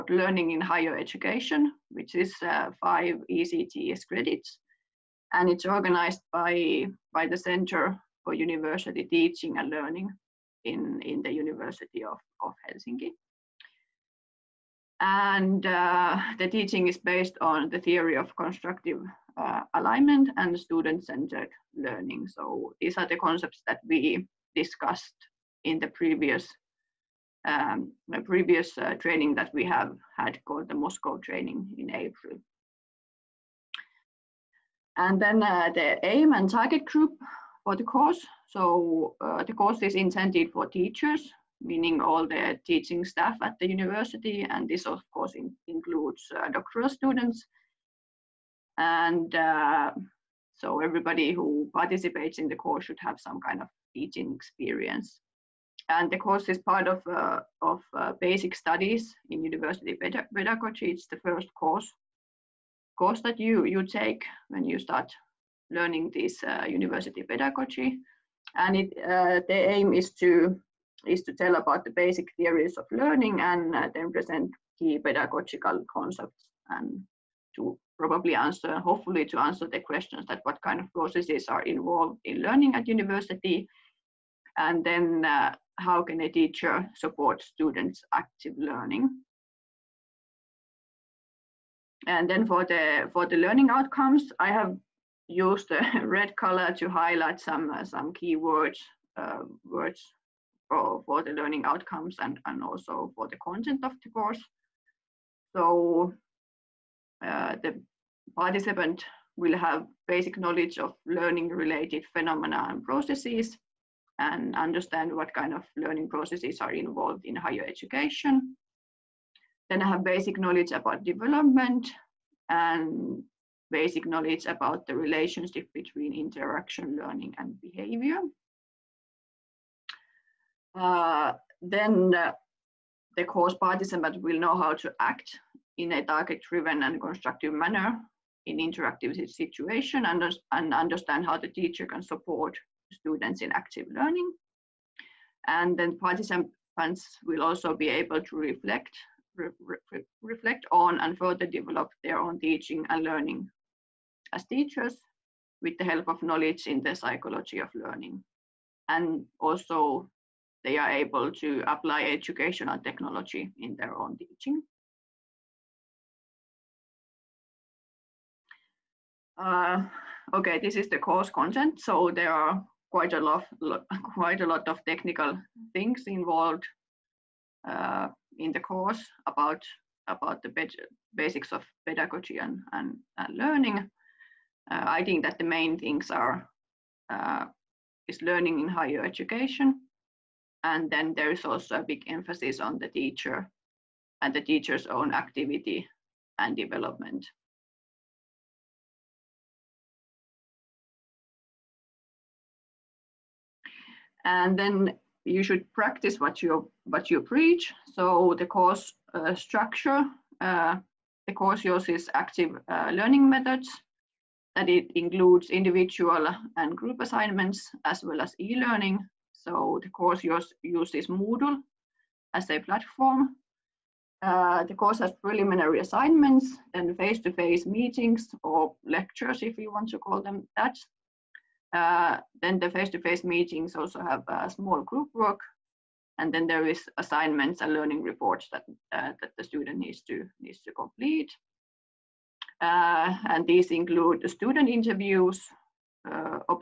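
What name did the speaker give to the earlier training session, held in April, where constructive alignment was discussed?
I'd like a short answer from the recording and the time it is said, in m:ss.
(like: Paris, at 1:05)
Moscow training, at 0:30.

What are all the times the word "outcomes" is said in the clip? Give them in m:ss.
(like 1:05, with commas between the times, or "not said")
1:33, 1:41.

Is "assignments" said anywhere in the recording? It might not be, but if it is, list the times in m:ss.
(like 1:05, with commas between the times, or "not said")
3:36, 3:45, 3:56.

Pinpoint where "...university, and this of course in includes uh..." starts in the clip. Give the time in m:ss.
0:43.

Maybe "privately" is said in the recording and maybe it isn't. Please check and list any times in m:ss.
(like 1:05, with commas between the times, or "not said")
not said.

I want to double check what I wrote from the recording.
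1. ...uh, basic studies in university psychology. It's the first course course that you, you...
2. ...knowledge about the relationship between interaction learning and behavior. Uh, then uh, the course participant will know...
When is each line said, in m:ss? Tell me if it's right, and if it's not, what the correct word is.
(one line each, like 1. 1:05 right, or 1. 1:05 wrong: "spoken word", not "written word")
1. 0:57 wrong: "pedagogy", not "psychology"
2. 2:04 right.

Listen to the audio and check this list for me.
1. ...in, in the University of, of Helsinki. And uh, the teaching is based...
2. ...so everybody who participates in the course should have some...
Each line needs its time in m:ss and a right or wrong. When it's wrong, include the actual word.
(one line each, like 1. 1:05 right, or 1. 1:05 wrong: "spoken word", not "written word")
1. 0:10 right
2. 0:50 right.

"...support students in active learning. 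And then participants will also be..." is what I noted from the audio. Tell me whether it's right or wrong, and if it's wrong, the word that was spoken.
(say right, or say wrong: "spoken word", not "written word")
right.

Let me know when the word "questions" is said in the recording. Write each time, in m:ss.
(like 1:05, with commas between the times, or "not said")
1:19.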